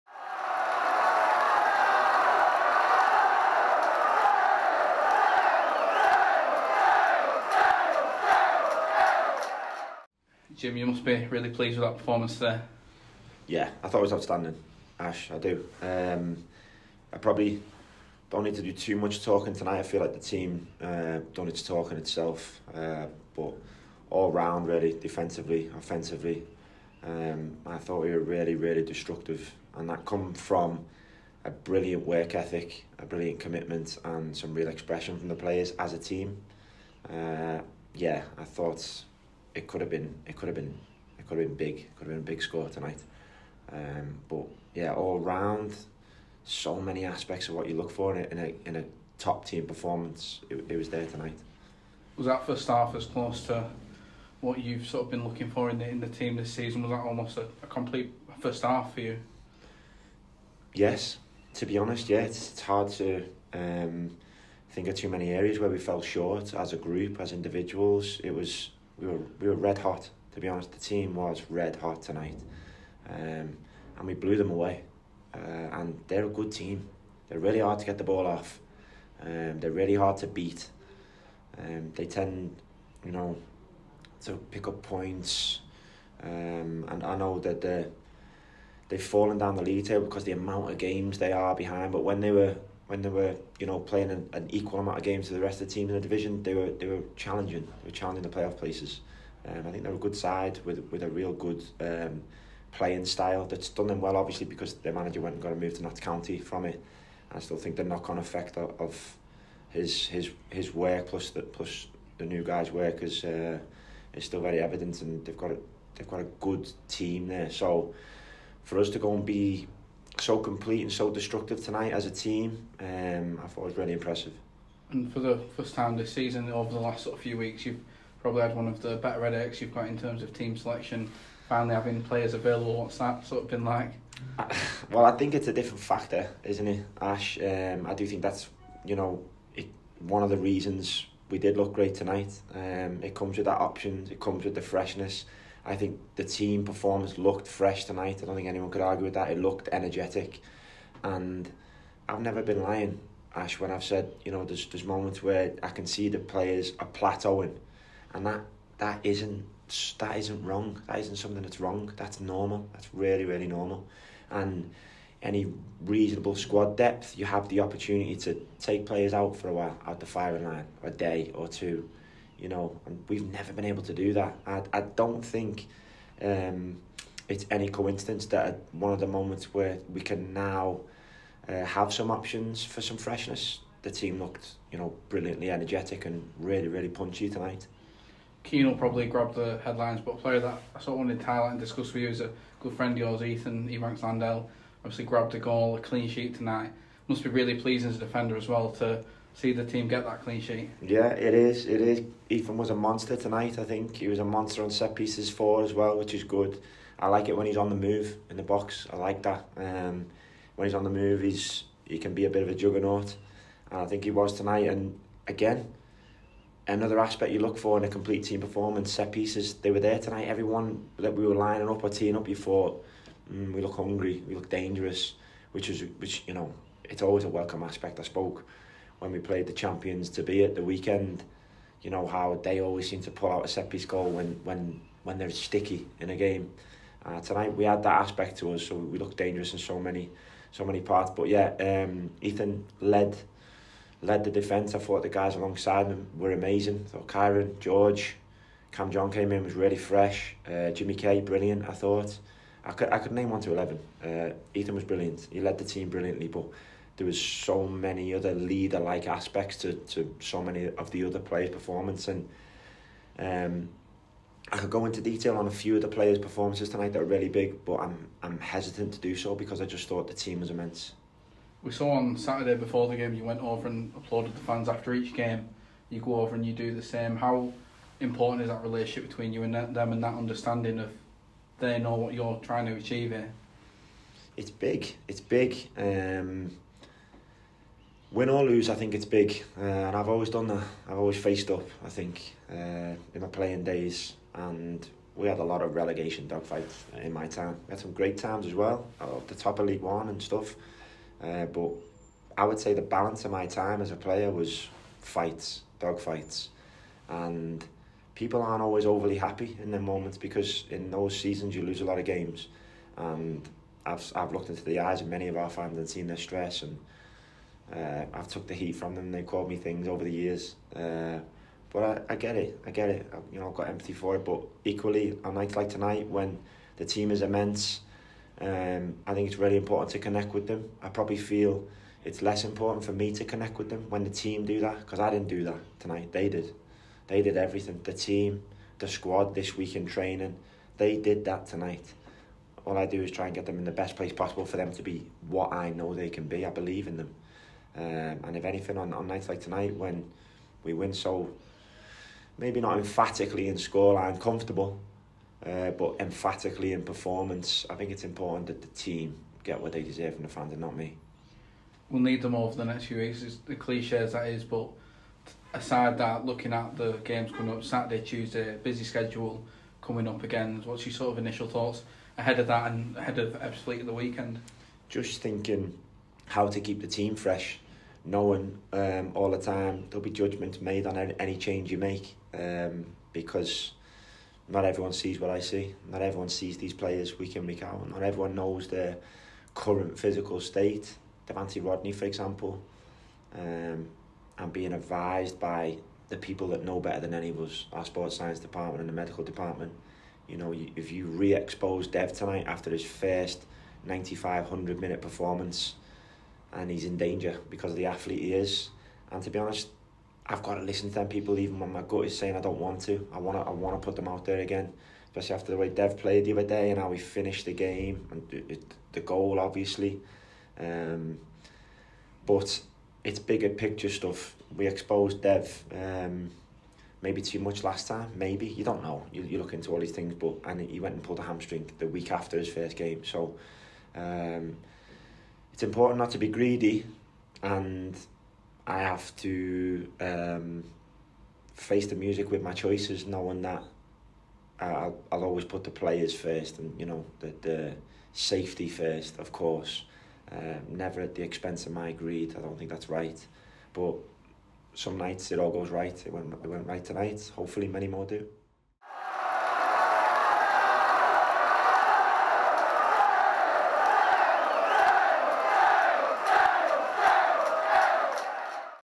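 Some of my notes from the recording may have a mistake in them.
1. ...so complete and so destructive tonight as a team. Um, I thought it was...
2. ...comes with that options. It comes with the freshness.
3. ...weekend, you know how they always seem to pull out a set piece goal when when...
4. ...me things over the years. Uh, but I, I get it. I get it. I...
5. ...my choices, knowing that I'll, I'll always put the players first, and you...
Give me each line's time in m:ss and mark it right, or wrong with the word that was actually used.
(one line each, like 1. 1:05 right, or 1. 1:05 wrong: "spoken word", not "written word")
1. 2:00 right
2. 2:23 right
3. 3:50 right
4. 5:19 right
5. 7:22 right.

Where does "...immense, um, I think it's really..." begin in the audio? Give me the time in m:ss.
5:27.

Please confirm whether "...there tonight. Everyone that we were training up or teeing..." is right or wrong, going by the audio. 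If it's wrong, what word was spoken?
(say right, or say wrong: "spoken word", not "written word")
wrong: "lining", not "training".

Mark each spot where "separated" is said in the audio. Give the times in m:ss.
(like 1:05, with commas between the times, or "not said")
not said.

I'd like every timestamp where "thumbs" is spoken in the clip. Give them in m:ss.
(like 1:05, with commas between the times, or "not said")
not said.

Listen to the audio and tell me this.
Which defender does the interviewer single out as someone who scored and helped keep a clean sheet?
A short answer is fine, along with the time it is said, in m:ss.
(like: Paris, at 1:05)
Ethan Ebanks Landell, at 3:13.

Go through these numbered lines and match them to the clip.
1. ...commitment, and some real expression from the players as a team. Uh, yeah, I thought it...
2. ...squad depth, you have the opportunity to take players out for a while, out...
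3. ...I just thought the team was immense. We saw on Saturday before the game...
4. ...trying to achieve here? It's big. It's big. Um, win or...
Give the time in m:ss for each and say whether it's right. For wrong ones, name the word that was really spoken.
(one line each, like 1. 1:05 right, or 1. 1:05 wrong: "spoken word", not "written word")
1. 0:33 right
2. 2:46 right
3. 4:29 right
4. 4:42 right.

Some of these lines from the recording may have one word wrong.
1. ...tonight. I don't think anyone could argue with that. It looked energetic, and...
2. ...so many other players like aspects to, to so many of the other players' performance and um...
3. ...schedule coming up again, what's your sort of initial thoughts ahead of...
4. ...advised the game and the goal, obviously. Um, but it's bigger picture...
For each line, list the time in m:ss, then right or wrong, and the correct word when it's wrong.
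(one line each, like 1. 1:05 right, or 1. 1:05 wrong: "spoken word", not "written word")
1. 2:27 right
2. 4:17 wrong: "leader", not "players"
3. 6:08 right
4. 6:56 wrong: "finished", not "advised".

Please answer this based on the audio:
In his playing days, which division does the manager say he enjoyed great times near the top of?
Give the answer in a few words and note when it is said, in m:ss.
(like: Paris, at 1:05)
League One, at 4:59.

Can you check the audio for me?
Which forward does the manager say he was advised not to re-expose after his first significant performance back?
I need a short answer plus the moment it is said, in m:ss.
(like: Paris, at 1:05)
Devante Rodney, at 6:31.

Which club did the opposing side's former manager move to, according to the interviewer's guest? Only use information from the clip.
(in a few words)
Notts County.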